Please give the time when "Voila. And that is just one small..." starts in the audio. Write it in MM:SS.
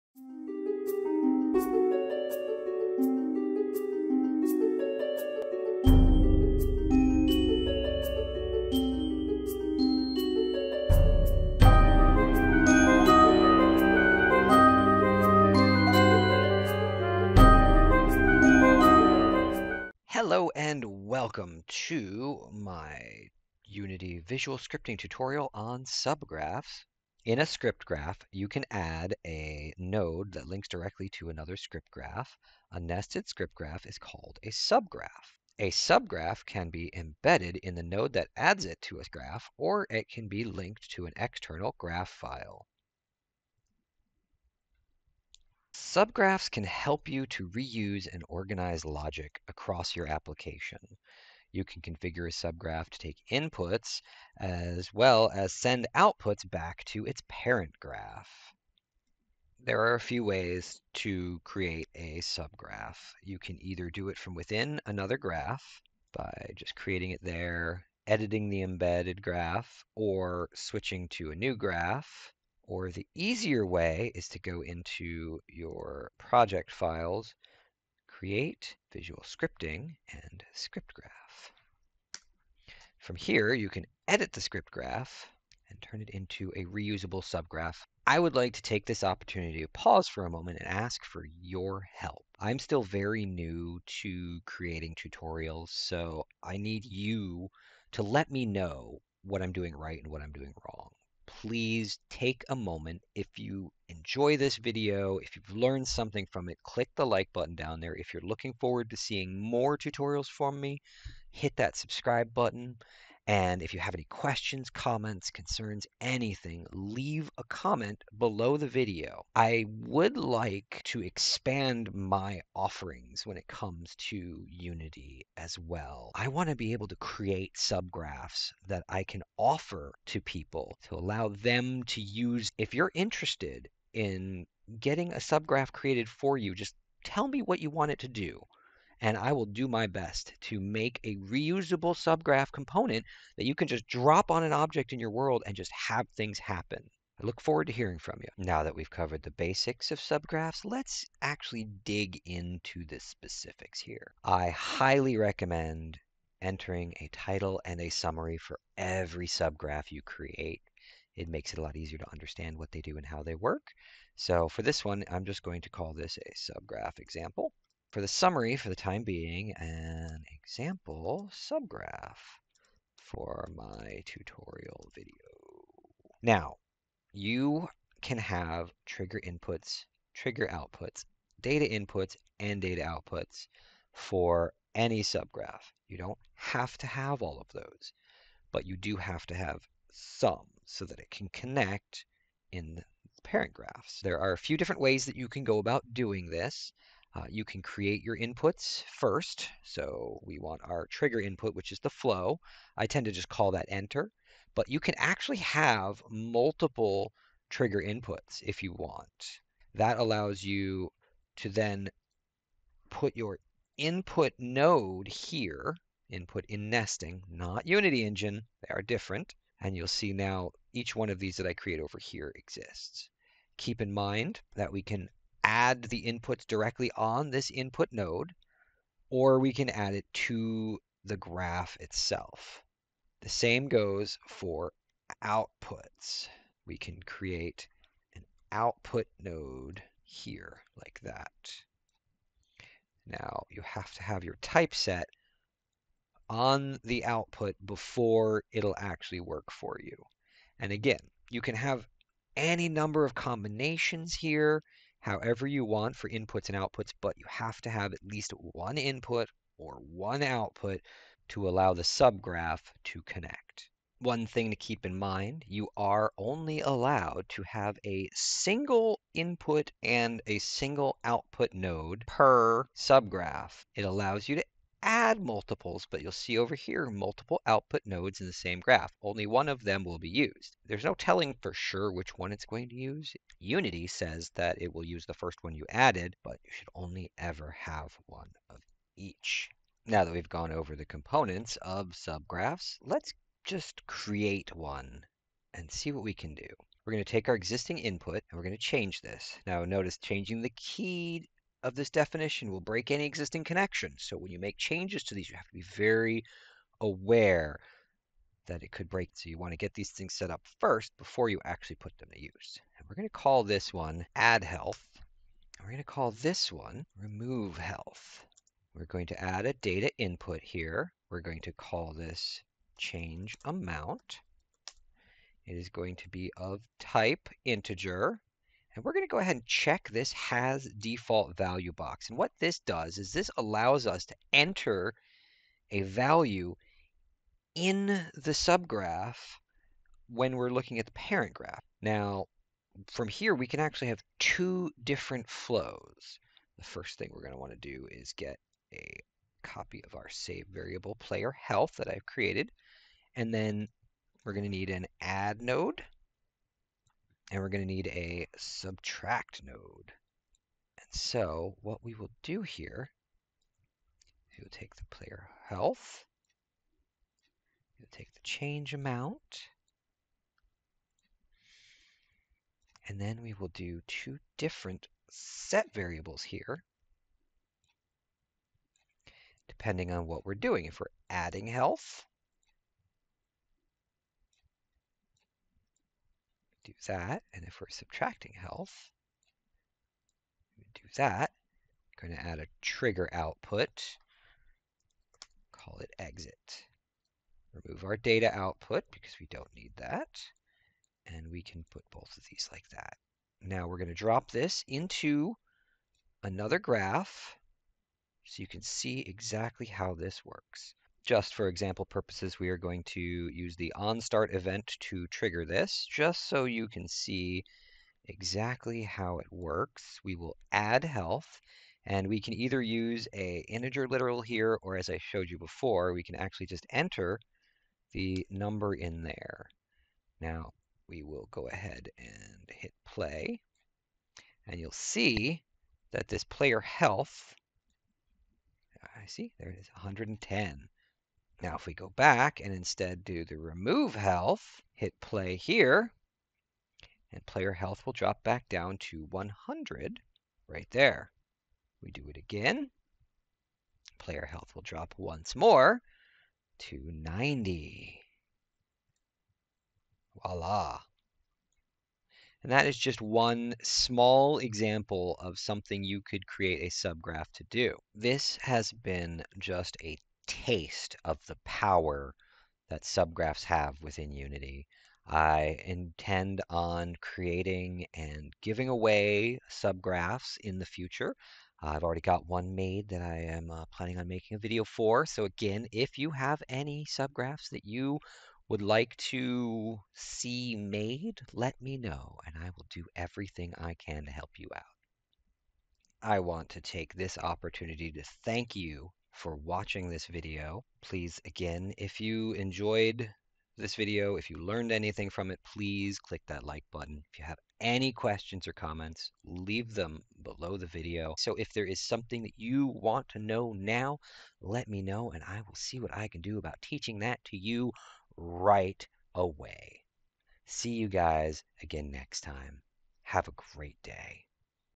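07:40.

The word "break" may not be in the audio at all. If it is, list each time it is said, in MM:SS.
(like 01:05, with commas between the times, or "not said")
05:02, 05:08.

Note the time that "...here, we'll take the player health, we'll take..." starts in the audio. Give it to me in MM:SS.
06:02.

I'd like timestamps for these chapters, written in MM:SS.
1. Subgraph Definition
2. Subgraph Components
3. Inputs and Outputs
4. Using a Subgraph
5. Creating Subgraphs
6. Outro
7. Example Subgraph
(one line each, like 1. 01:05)
1. 00:27
2. 02:28
3. 02:56
4. 06:43
5. 00:59
6. 07:47
7. 04:49.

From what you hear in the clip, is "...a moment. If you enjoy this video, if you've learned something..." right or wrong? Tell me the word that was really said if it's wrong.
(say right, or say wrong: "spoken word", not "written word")
right.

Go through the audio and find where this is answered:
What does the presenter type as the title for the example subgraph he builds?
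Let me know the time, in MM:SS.
02:46.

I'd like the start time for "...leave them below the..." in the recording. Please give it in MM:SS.
08:29.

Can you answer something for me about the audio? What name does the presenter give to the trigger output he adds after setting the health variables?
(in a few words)
exit.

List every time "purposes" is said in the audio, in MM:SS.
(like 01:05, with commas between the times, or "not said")
06:51.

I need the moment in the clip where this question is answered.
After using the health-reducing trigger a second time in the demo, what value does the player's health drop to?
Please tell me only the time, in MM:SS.
07:36.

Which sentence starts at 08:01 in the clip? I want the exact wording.
I've already got one made that I am uh, planning on making a video for.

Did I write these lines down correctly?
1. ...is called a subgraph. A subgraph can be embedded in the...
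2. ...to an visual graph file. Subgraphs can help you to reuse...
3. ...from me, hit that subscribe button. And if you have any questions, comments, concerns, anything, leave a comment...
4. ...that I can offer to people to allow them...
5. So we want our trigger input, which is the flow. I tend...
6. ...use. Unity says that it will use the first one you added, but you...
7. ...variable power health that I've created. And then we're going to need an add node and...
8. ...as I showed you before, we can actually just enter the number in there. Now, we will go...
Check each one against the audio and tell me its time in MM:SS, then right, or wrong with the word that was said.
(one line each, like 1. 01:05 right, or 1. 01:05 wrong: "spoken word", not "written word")
1. 00:33 right
2. 00:40 wrong: "external", not "visual"
3. 01:50 right
4. 02:08 right
5. 03:19 right
6. 04:42 right
7. 05:50 wrong: "player", not "power"
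8. 07:04 right.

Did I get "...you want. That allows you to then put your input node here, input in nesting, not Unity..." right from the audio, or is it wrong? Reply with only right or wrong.
right.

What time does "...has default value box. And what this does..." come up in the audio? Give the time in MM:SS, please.
05:30.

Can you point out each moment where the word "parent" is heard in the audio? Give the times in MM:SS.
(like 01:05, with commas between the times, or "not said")
00:57, 03:13, 05:40.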